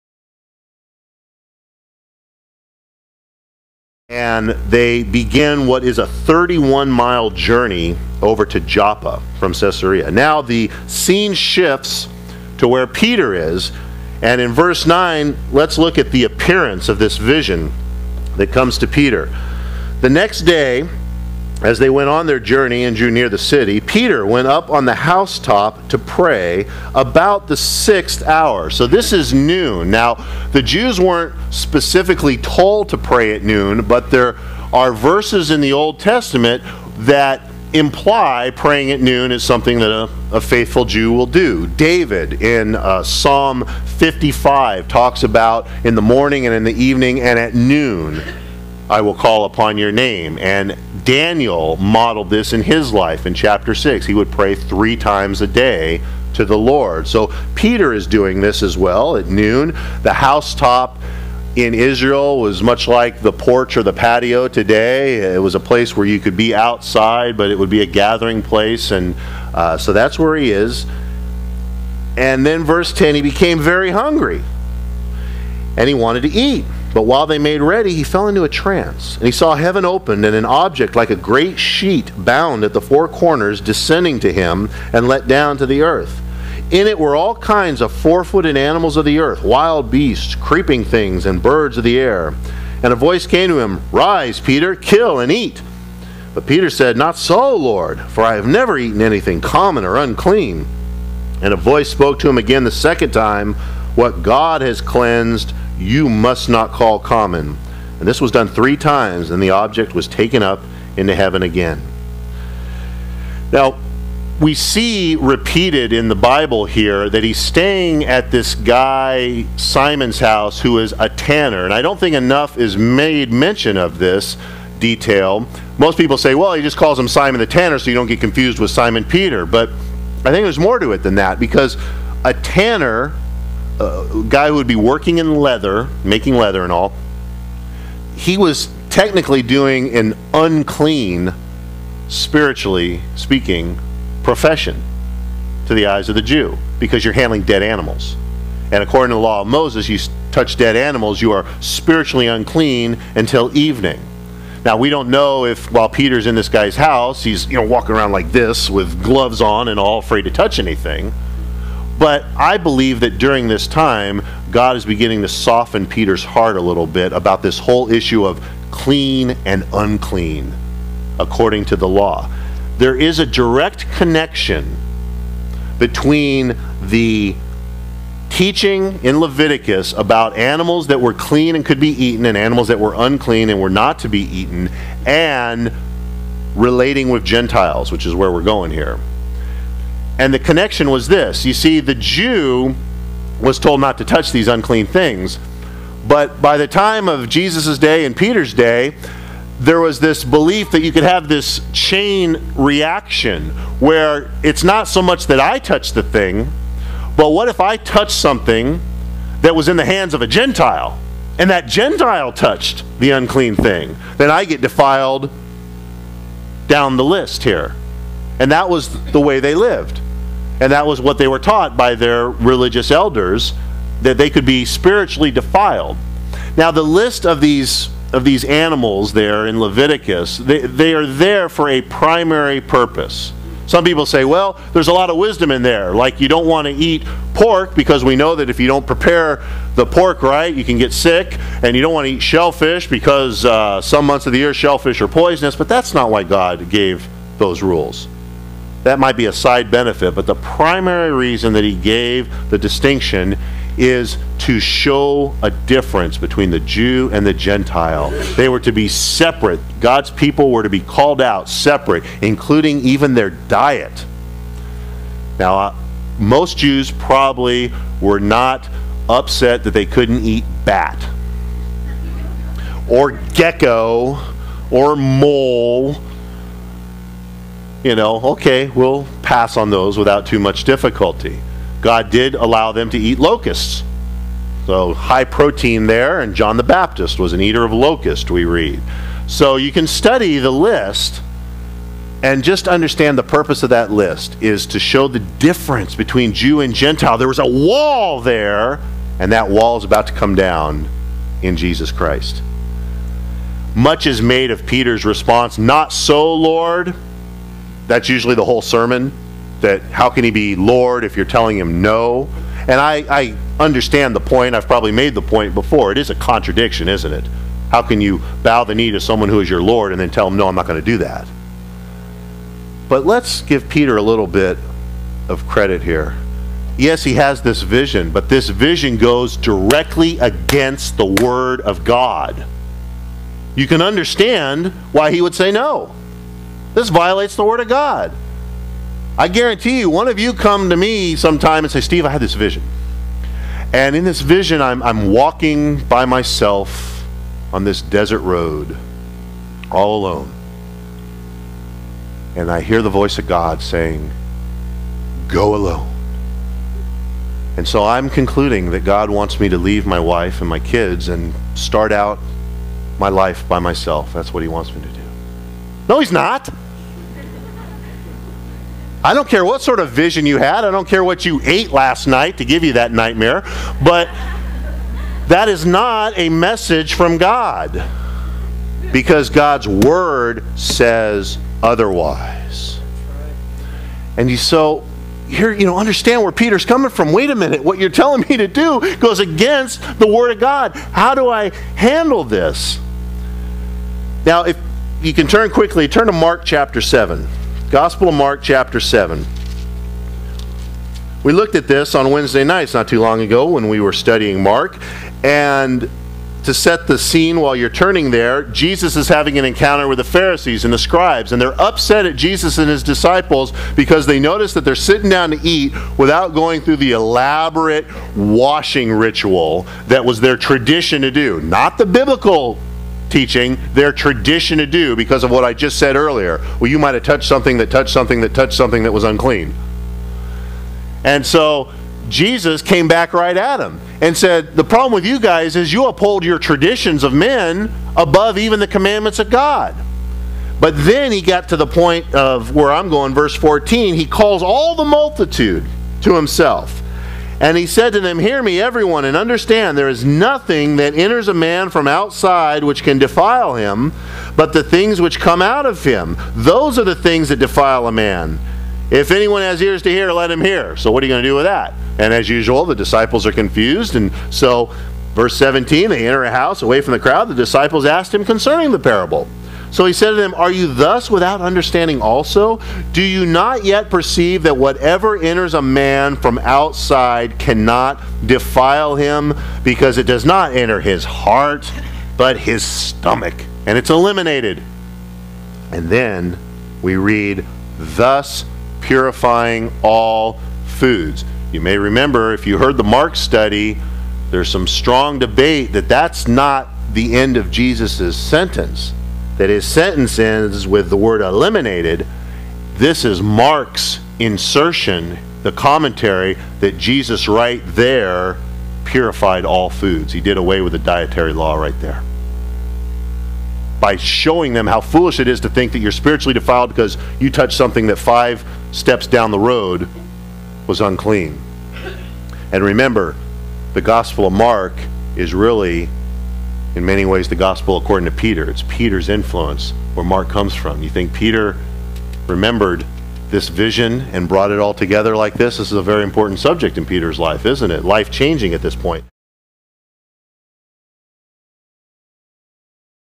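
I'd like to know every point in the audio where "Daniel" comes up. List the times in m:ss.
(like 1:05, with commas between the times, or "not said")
0:51.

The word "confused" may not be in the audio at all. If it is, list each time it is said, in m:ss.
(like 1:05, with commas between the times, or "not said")
2:08, 7:43.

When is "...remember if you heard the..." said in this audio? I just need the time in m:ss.
8:11.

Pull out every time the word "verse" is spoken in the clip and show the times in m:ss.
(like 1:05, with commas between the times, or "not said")
0:14, 0:34, 1:12, 7:23, 7:45.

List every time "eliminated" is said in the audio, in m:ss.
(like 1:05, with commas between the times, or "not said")
8:03, 8:21.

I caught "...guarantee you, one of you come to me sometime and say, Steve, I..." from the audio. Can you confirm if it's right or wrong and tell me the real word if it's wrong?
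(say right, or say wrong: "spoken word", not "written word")
right.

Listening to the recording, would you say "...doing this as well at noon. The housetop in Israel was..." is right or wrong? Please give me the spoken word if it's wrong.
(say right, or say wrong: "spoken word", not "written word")
right.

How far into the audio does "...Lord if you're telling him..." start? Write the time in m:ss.
5:10.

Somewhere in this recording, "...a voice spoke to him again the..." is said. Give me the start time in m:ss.
1:41.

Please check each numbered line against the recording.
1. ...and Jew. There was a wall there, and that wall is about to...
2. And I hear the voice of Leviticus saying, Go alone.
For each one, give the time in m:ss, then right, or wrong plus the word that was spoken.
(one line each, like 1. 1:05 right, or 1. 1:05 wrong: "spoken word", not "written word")
1. 4:56 wrong: "Gentile", not "Jew"
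2. 5:52 wrong: "God", not "Leviticus".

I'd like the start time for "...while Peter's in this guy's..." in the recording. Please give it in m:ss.
2:35.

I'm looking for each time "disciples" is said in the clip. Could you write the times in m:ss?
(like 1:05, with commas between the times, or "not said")
6:52, 7:42, 7:47.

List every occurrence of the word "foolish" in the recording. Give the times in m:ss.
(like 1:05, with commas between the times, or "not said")
8:34.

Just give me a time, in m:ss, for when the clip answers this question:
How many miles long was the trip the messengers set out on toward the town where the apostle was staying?
0:06.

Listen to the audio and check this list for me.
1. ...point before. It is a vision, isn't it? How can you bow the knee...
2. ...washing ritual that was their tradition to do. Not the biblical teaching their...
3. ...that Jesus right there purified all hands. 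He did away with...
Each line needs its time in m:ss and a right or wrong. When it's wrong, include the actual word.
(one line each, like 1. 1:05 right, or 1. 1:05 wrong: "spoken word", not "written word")
1. 5:15 wrong: "contradiction", not "vision"
2. 6:58 right
3. 8:26 wrong: "foods", not "hands".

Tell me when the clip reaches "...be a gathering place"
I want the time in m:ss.
1:07.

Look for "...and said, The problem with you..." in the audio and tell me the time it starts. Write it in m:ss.
7:14.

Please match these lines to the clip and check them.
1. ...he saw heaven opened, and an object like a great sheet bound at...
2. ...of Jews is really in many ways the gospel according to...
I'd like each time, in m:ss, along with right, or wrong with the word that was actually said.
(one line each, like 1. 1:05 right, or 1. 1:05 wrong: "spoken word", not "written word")
1. 1:19 right
2. 8:44 wrong: "Mark", not "Jews".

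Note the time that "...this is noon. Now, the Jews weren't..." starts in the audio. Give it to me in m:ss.
0:28.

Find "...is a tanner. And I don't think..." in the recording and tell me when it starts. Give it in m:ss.
2:00.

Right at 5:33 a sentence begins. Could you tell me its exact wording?
You can understand why he would say no.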